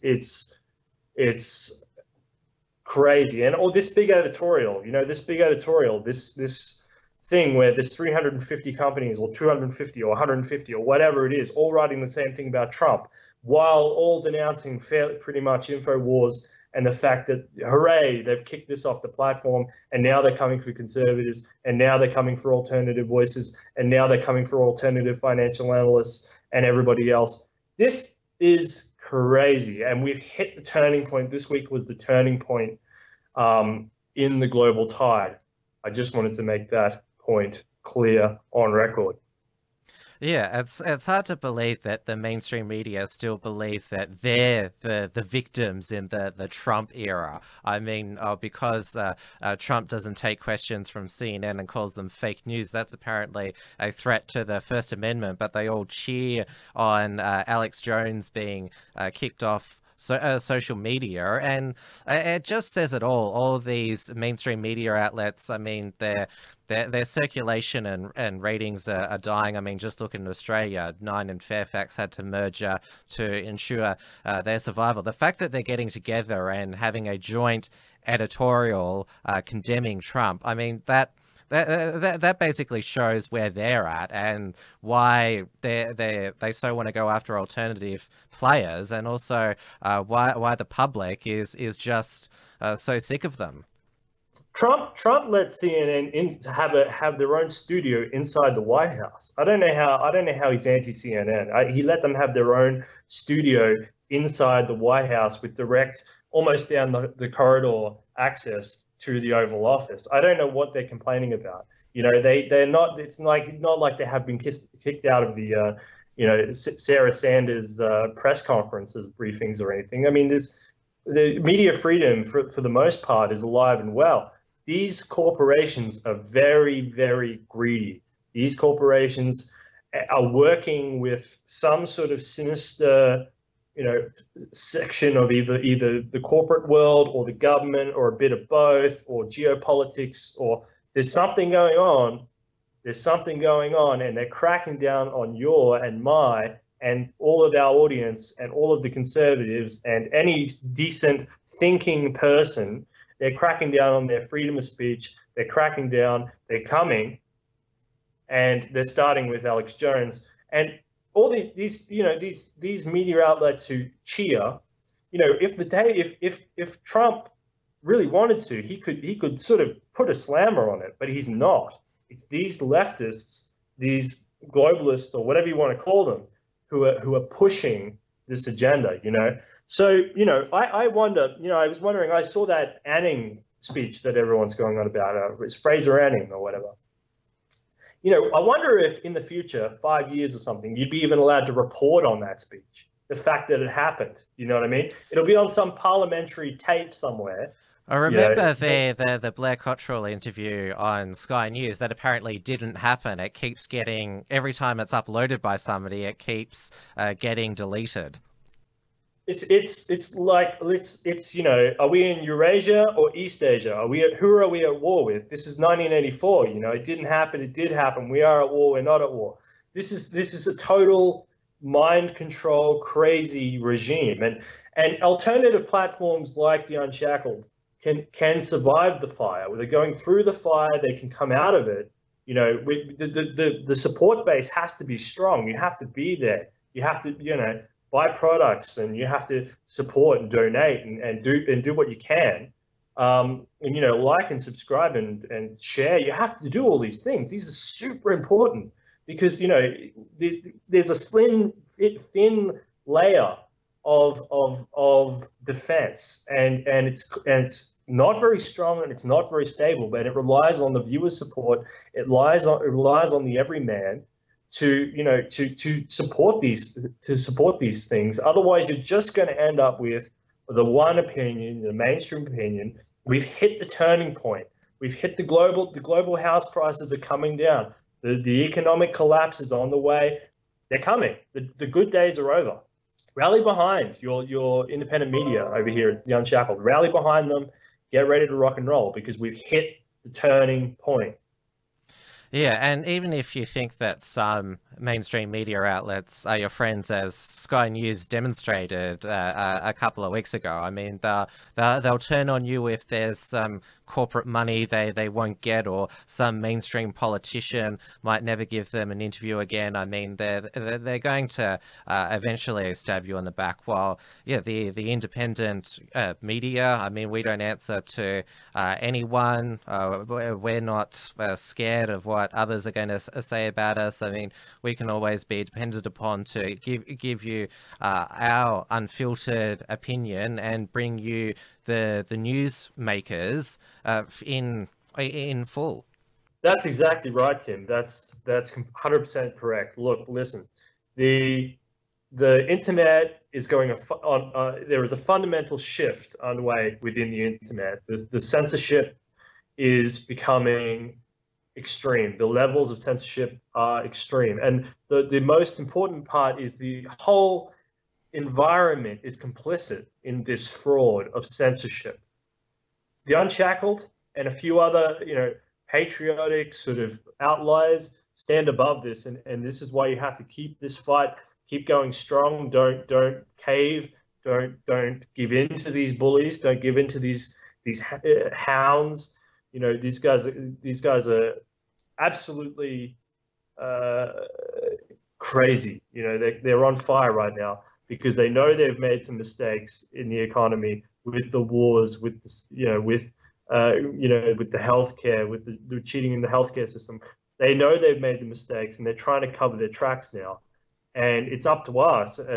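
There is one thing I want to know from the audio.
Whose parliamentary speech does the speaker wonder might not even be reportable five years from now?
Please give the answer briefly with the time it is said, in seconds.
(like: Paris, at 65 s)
Fraser Anning, at 185 s.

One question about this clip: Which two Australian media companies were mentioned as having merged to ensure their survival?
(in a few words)
Nine and Fairfax.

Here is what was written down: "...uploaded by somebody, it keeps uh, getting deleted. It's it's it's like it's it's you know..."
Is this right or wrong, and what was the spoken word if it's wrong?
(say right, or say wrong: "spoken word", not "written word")
right.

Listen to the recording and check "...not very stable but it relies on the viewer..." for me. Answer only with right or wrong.
right.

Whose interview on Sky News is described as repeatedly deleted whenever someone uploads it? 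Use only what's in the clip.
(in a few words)
Blair Cottrell.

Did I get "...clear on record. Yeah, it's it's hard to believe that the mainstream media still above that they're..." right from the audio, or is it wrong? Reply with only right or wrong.
wrong.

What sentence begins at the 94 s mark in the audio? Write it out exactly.
Trump Trump let CNN in, have a, have their own studio inside the White House.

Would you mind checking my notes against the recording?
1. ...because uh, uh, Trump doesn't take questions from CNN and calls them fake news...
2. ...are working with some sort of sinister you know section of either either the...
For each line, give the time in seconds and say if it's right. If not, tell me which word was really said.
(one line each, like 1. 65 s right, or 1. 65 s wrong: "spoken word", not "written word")
1. 48 s right
2. 130 s right.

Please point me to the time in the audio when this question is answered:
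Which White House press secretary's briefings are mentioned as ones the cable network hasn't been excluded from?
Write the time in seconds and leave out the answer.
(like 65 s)
116 s.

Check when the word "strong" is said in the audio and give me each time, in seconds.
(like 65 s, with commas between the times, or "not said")
234 s, 258 s, 371 s.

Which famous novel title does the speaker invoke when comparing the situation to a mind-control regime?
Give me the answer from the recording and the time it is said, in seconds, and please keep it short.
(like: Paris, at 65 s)
1984, at 215 s.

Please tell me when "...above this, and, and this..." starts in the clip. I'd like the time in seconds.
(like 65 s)
368 s.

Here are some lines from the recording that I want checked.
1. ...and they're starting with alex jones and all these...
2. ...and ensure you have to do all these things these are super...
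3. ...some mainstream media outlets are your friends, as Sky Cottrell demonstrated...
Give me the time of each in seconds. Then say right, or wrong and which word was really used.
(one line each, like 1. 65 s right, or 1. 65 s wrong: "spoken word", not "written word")
1. 158 s right
2. 245 s wrong: "share", not "ensure"
3. 294 s wrong: "News", not "Cottrell".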